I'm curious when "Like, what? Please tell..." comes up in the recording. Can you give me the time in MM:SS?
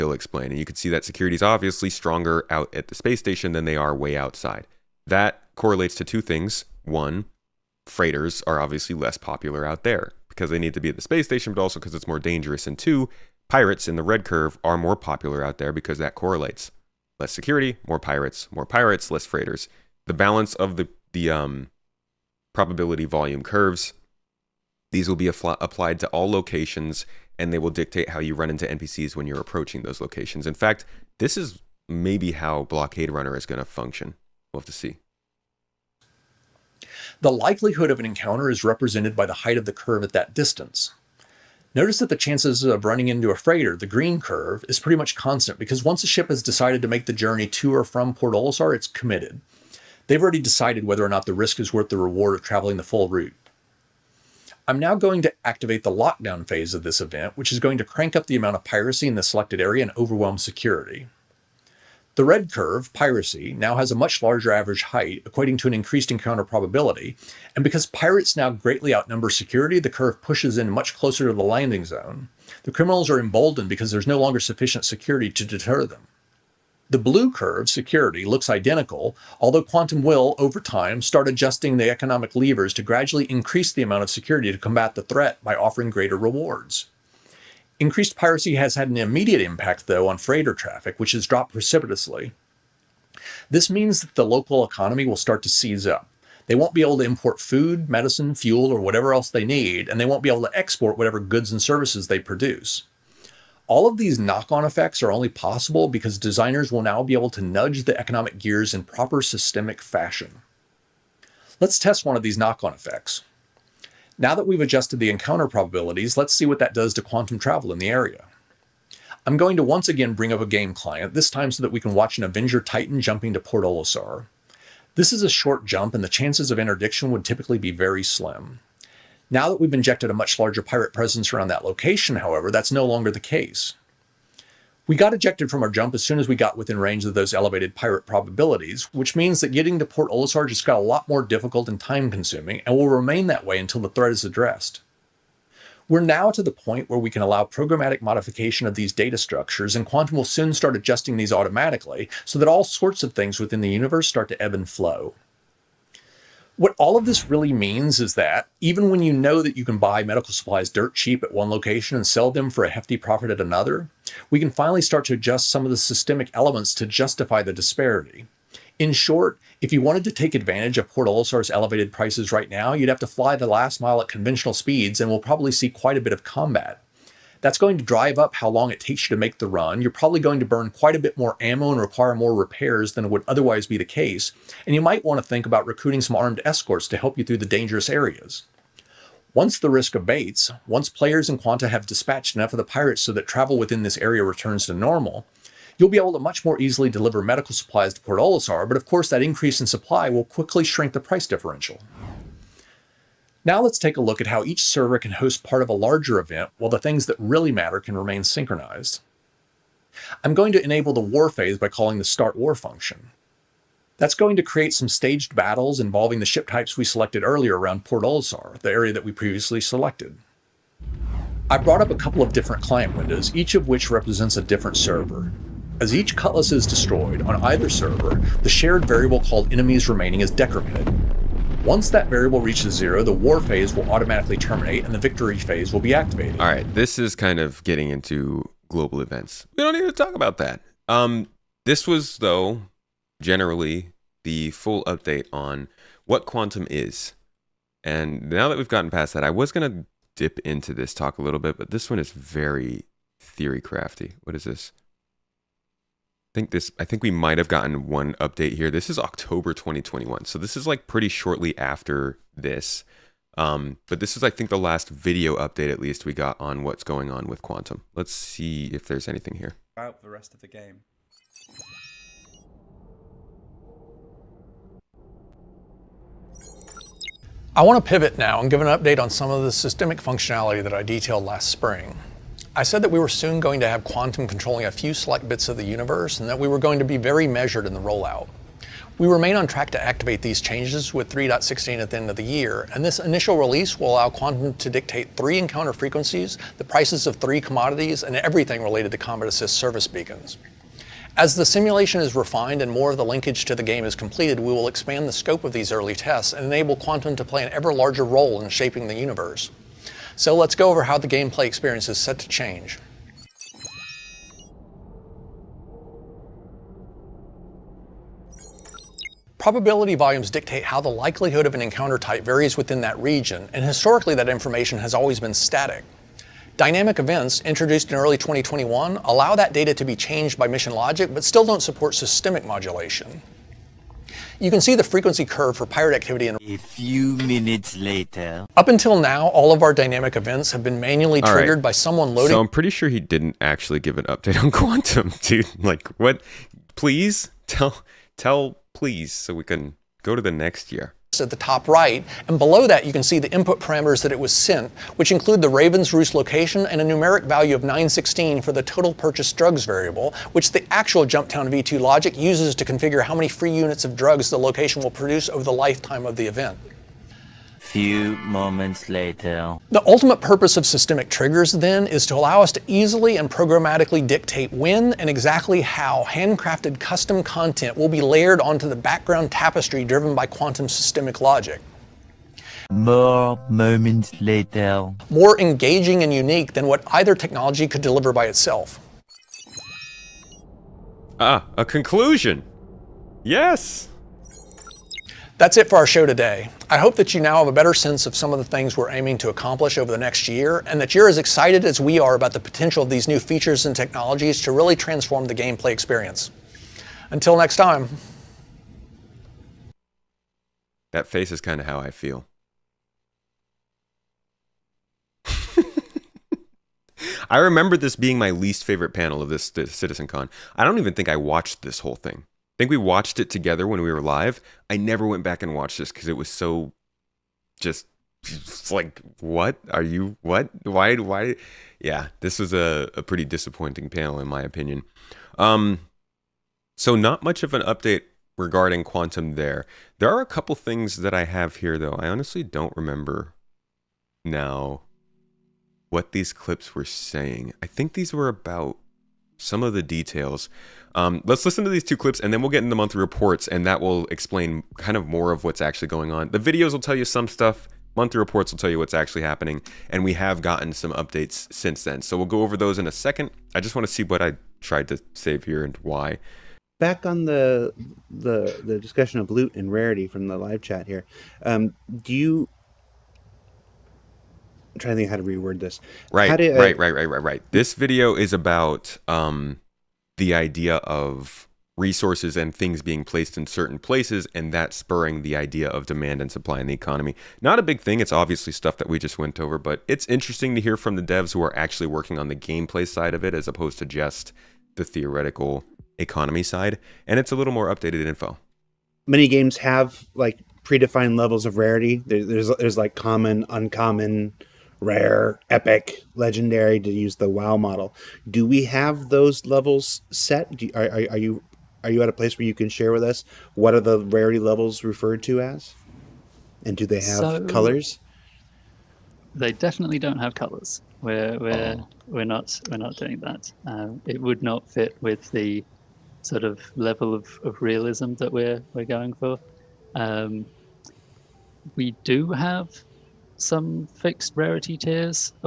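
05:45.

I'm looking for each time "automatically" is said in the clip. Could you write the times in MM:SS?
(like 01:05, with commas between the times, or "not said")
02:31, 03:53.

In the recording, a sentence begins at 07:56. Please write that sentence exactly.
Right, how do, right, right, right, right, right.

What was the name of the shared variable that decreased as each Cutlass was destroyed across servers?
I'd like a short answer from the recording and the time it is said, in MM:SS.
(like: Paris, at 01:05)
enemies remaining, at 03:49.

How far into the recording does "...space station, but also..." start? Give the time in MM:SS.
00:11.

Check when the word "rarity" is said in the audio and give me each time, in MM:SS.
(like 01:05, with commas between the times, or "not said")
07:49, 08:21, 08:34, 08:54.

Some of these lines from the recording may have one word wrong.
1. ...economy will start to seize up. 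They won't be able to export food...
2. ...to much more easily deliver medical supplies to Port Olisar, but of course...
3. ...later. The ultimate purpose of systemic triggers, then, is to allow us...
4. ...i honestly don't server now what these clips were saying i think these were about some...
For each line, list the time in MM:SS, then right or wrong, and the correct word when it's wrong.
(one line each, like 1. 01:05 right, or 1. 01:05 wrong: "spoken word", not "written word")
1. 01:34 wrong: "import", not "export"
2. 03:16 right
3. 06:08 right
4. 07:21 wrong: "remember", not "server".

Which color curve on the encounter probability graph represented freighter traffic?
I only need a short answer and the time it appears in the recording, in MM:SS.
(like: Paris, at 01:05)
Green, at 00:43.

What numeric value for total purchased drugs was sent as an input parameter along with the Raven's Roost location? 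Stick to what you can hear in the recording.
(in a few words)
916.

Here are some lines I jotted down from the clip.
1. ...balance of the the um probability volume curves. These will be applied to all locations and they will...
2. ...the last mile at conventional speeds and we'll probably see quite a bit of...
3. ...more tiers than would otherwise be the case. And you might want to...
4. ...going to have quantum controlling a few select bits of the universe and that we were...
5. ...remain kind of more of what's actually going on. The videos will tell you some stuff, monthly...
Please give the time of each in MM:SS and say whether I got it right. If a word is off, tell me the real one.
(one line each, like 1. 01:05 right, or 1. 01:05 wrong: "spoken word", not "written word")
1. 00:20 right
2. 02:53 right
3. 03:02 wrong: "repairs", not "tiers"
4. 04:43 right
5. 07:34 wrong: "explain", not "remain".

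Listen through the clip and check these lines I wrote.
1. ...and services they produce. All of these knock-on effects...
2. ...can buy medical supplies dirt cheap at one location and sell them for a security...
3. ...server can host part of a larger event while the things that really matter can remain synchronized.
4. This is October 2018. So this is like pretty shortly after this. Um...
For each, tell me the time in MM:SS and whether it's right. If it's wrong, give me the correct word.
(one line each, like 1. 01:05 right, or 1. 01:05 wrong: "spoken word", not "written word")
1. 01:41 right
2. 02:39 wrong: "hefty", not "security"
3. 03:24 right
4. 04:18 wrong: "2021", not "2018".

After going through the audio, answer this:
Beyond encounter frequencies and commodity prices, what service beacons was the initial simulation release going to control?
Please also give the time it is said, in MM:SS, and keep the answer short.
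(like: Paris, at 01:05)
Combat Assist, at 04:58.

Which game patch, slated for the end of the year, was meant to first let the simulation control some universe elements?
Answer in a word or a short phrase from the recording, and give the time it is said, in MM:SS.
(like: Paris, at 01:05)
3.16, at 04:51.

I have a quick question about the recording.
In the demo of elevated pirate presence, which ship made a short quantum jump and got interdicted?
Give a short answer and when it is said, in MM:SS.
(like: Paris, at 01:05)
Avenger Titan, at 02:02.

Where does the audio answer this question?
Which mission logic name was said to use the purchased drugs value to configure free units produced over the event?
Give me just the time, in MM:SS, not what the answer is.
06:01.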